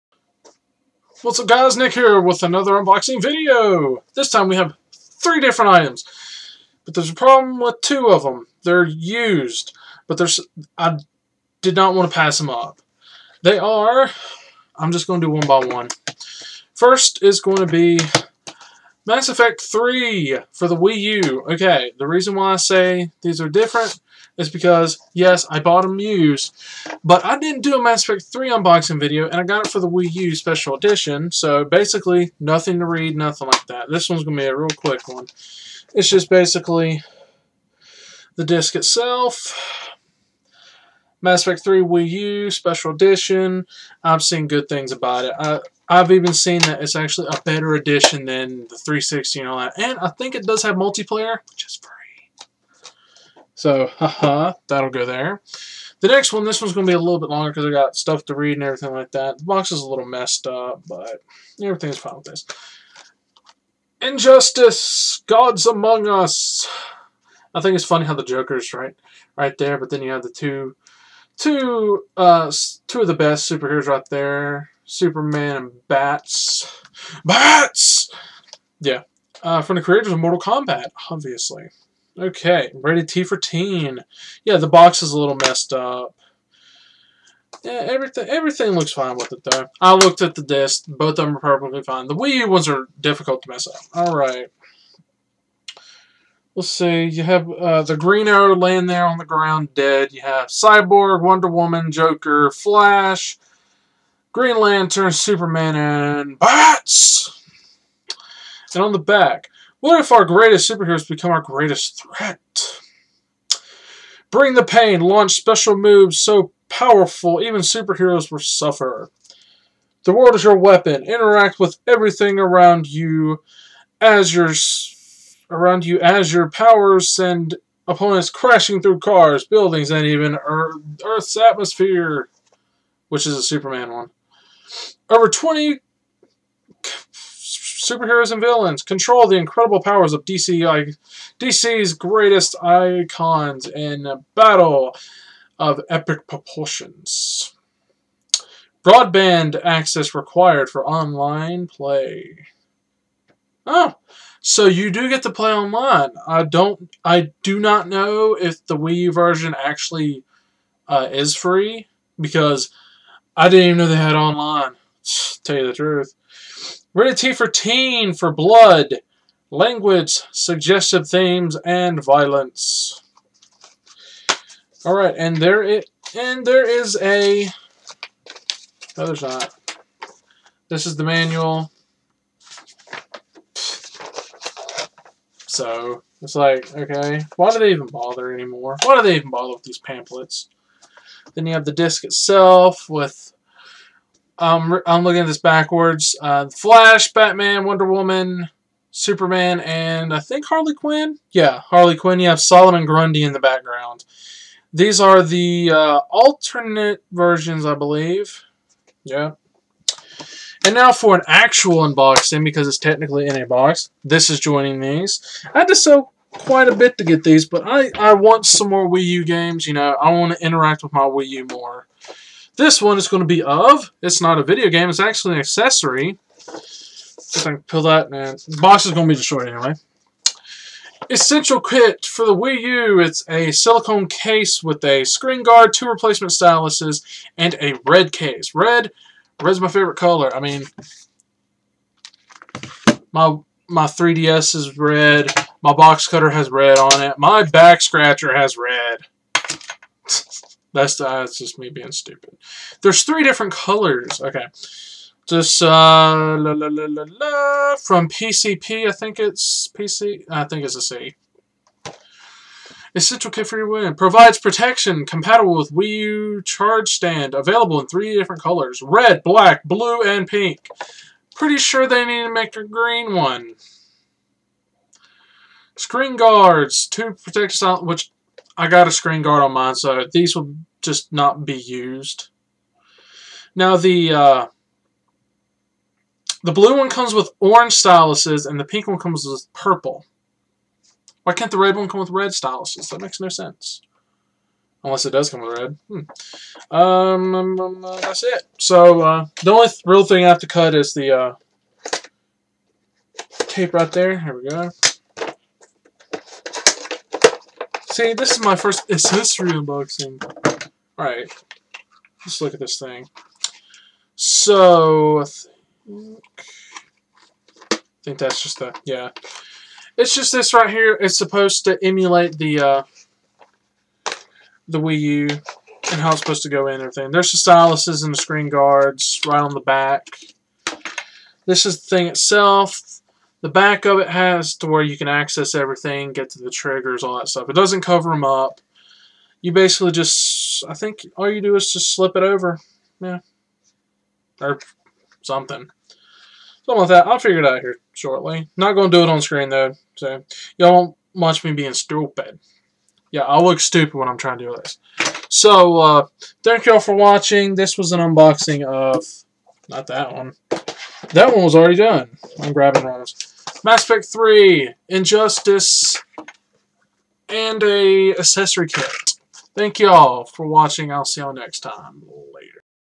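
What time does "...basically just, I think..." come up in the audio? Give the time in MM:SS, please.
05:39.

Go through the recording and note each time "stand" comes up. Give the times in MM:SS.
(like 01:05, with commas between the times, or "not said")
04:26.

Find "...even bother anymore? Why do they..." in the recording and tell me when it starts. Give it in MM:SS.
03:07.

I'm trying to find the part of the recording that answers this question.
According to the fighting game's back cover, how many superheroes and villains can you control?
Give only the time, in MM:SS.
02:15.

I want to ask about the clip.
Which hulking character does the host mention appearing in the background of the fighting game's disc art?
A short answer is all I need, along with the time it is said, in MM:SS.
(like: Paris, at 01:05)
Solomon Grundy, at 03:22.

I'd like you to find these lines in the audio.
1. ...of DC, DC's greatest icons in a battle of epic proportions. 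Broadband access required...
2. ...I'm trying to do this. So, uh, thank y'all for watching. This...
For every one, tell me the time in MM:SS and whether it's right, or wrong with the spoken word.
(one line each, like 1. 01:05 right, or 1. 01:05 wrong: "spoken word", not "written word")
1. 02:20 right
2. 05:54 right.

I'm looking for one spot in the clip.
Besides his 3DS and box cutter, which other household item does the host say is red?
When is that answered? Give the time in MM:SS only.
04:07.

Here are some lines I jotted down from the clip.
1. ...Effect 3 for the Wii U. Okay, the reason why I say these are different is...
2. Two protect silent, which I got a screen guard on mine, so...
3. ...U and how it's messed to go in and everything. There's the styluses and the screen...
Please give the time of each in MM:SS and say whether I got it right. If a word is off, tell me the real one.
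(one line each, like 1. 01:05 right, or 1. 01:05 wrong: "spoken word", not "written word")
1. 00:19 right
2. 04:36 right
3. 05:24 wrong: "supposed", not "messed".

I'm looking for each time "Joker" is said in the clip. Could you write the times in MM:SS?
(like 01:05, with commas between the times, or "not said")
01:08, 01:41.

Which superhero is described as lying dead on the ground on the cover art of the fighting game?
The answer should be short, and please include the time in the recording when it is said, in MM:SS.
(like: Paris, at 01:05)
Green Arrow, at 01:37.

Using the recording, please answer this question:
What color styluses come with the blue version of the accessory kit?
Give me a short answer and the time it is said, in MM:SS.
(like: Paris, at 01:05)
orange, at 04:47.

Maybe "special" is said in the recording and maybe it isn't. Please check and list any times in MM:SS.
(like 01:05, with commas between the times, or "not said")
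00:30, 00:42, 01:55.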